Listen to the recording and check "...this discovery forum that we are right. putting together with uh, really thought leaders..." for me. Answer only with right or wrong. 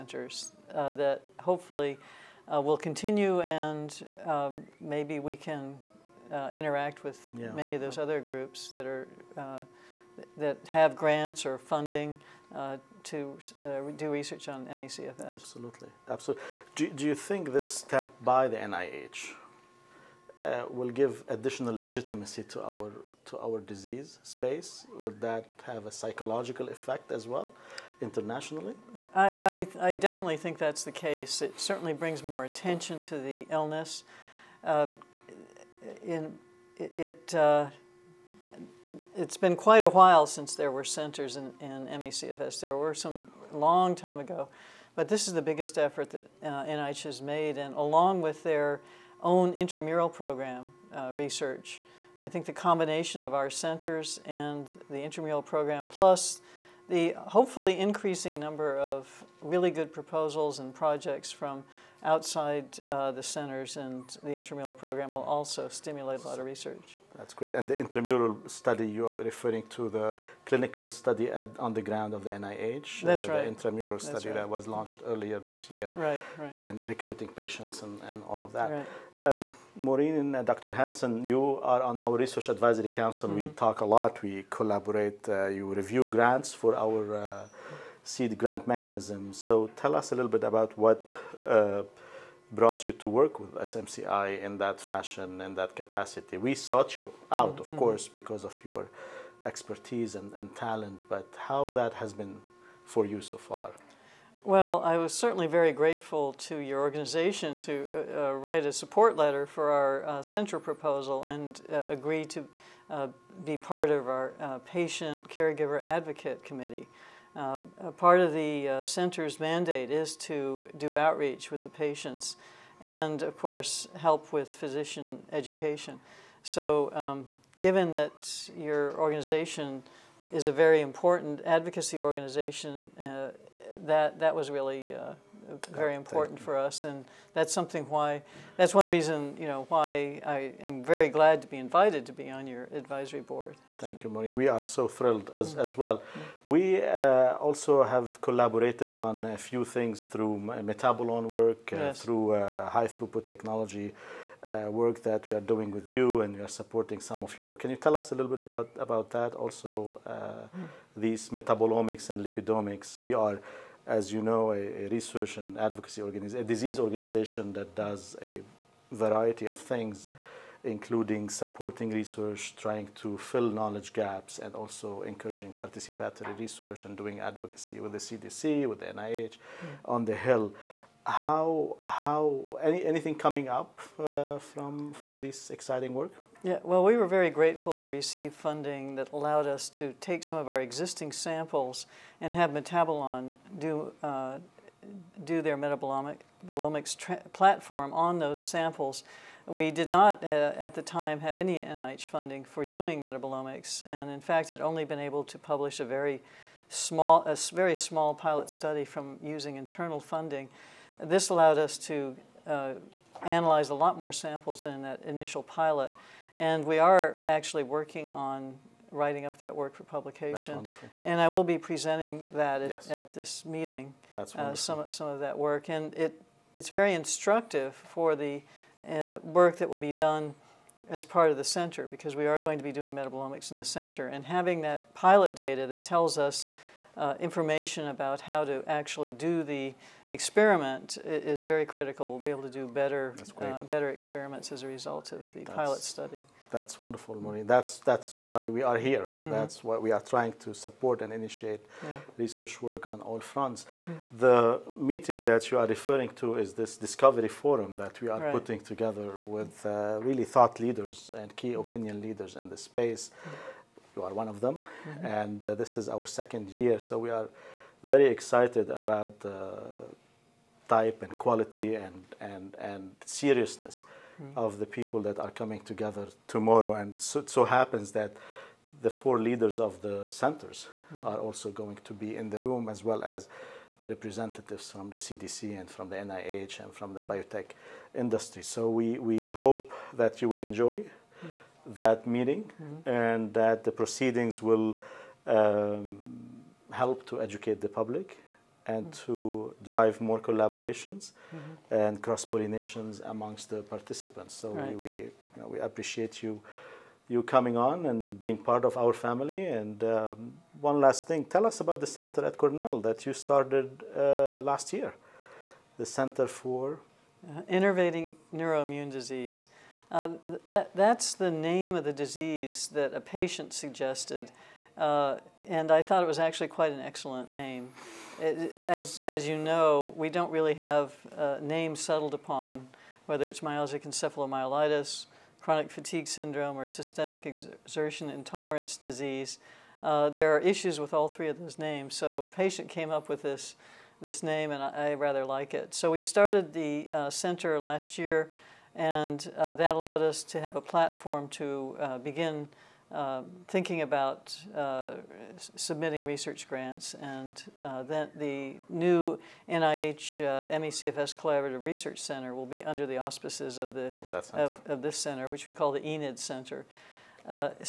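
right.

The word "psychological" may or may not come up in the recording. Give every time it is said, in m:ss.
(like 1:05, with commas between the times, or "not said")
0:25.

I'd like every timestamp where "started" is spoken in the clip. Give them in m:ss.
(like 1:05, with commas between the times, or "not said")
5:13, 5:46.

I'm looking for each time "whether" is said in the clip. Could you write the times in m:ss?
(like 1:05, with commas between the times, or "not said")
5:33.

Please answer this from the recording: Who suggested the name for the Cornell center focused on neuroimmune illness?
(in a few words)
A patient.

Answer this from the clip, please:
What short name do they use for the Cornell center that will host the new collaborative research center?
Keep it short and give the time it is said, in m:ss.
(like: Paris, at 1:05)
Enid Center, at 6:05.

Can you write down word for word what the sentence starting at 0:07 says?
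many of those other groups that are uh, that have grants or funding uh, to do research on MECFS.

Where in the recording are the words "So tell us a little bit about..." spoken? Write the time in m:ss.
1:29.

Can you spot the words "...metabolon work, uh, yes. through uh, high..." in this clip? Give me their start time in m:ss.
2:30.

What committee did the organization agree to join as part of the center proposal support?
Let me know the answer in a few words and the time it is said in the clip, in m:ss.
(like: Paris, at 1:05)
patient caregiver advocate committee, at 1:54.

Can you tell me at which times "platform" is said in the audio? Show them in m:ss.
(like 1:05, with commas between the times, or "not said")
3:17, 5:50.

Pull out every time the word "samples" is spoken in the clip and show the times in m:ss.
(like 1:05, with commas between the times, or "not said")
3:11, 3:18, 3:34.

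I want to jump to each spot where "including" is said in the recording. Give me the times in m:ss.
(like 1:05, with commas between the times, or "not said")
2:50.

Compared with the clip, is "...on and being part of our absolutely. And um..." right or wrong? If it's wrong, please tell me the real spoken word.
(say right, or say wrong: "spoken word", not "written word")
wrong: "family", not "absolutely".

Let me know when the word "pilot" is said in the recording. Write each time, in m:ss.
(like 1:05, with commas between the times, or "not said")
3:28, 3:35, 3:54, 4:05.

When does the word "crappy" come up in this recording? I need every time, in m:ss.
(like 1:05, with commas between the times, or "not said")
not said.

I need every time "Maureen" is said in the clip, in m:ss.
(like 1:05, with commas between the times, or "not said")
1:19, 2:24, 4:07.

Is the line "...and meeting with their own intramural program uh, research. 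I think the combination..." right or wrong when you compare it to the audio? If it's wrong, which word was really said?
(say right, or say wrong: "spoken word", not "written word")
wrong: "along", not "meeting".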